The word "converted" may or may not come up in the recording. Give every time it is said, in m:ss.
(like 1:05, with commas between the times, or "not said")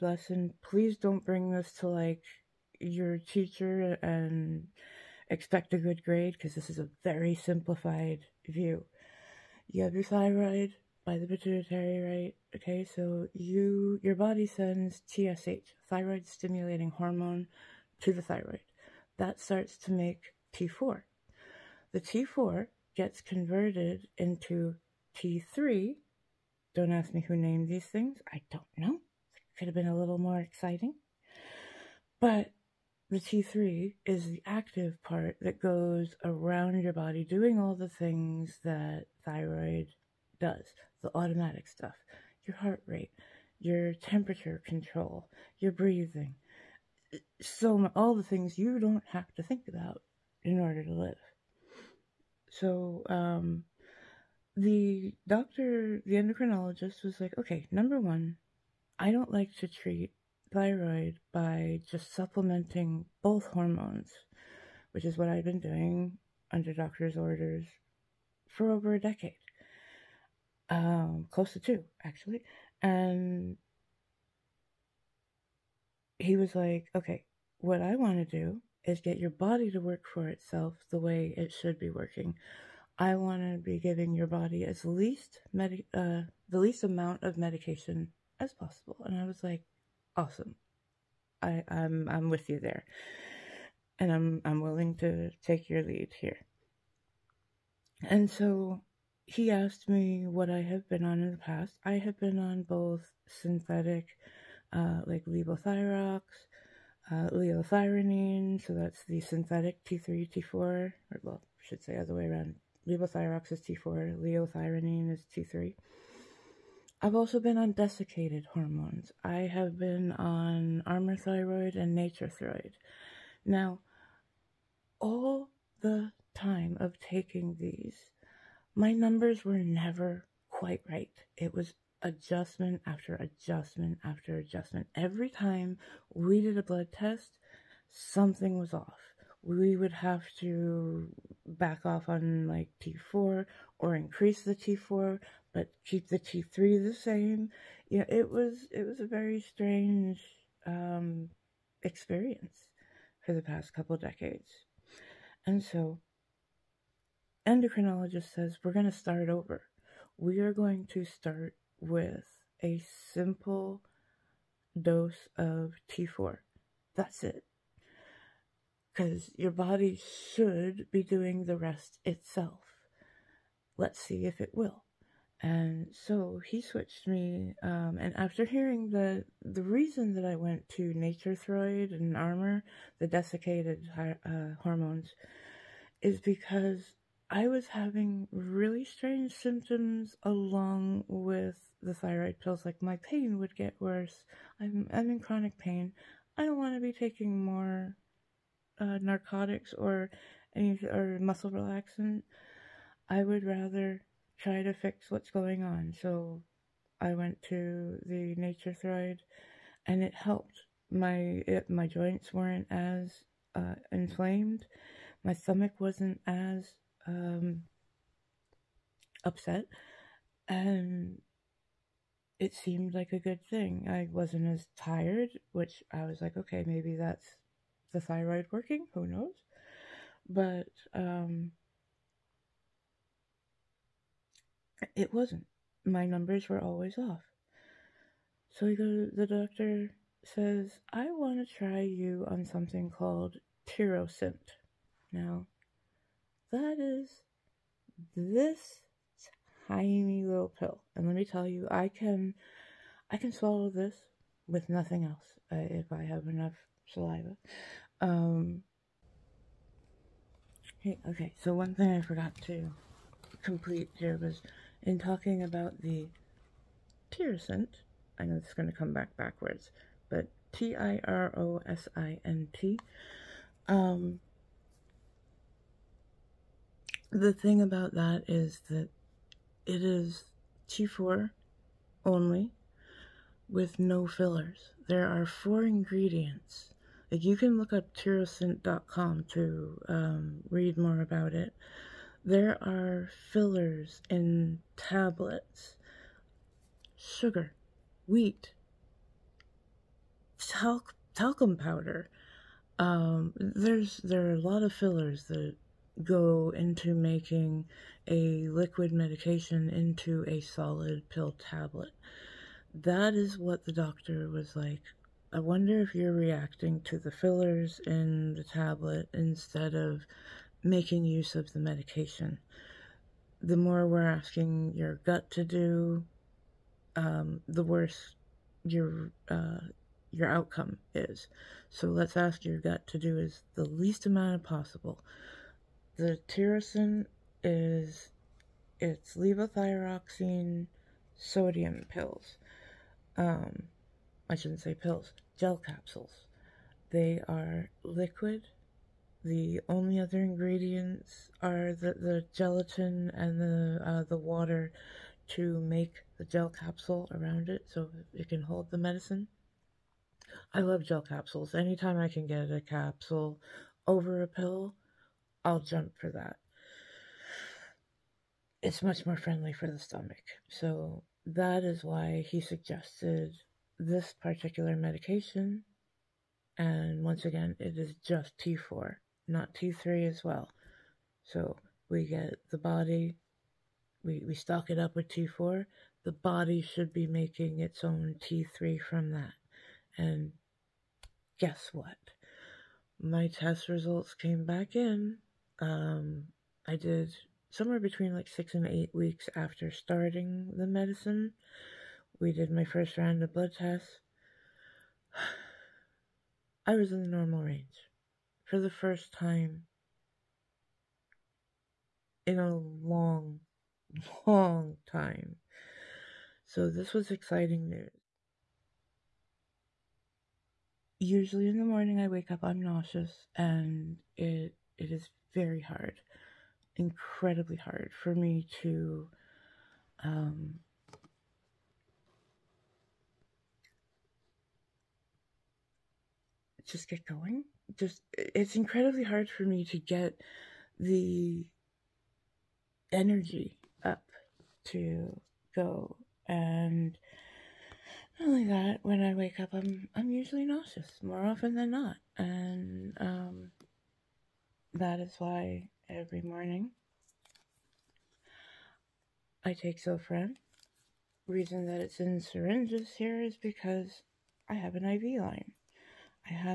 0:23.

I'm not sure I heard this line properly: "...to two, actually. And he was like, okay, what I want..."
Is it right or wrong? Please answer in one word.
right.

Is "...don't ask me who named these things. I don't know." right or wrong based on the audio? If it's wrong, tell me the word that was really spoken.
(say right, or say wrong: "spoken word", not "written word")
right.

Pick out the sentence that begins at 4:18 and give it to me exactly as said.
Um, hey, okay, so one thing I forgot to complete here was in talking about the Tirosint.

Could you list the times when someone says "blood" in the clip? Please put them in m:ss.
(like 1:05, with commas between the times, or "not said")
2:16, 6:43.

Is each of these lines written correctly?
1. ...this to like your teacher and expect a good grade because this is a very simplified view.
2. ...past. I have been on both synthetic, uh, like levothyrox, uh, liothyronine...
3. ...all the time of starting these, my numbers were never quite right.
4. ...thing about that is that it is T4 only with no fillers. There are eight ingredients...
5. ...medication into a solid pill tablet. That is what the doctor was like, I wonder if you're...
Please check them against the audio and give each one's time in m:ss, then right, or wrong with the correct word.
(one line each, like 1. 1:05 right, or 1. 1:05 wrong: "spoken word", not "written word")
1. 0:01 right
2. 1:41 right
3. 2:04 wrong: "taking", not "starting"
4. 4:37 wrong: "four", not "eight"
5. 5:08 right.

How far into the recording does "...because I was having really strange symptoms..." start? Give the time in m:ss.
3:06.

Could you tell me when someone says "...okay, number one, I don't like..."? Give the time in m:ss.
0:57.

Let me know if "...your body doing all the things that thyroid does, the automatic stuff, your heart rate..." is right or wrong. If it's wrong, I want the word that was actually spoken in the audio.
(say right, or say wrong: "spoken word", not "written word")
right.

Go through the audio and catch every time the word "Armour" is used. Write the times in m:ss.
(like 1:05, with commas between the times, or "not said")
2:00, 3:02.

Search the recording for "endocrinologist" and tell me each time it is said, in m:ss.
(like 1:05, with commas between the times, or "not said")
0:56, 2:37.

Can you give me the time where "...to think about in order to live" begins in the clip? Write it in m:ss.
0:49.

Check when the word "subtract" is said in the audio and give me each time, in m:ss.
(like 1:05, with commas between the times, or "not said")
not said.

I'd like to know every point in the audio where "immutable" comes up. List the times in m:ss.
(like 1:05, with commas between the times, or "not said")
not said.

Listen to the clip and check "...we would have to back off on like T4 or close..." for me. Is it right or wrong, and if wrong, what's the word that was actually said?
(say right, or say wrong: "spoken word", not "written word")
wrong: "increase", not "close".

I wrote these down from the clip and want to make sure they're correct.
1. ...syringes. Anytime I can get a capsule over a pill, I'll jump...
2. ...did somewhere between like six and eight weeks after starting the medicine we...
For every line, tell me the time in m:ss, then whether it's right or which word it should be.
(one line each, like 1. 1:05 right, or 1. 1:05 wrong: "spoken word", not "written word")
1. 6:01 wrong: "capsules", not "syringes"
2. 6:36 right.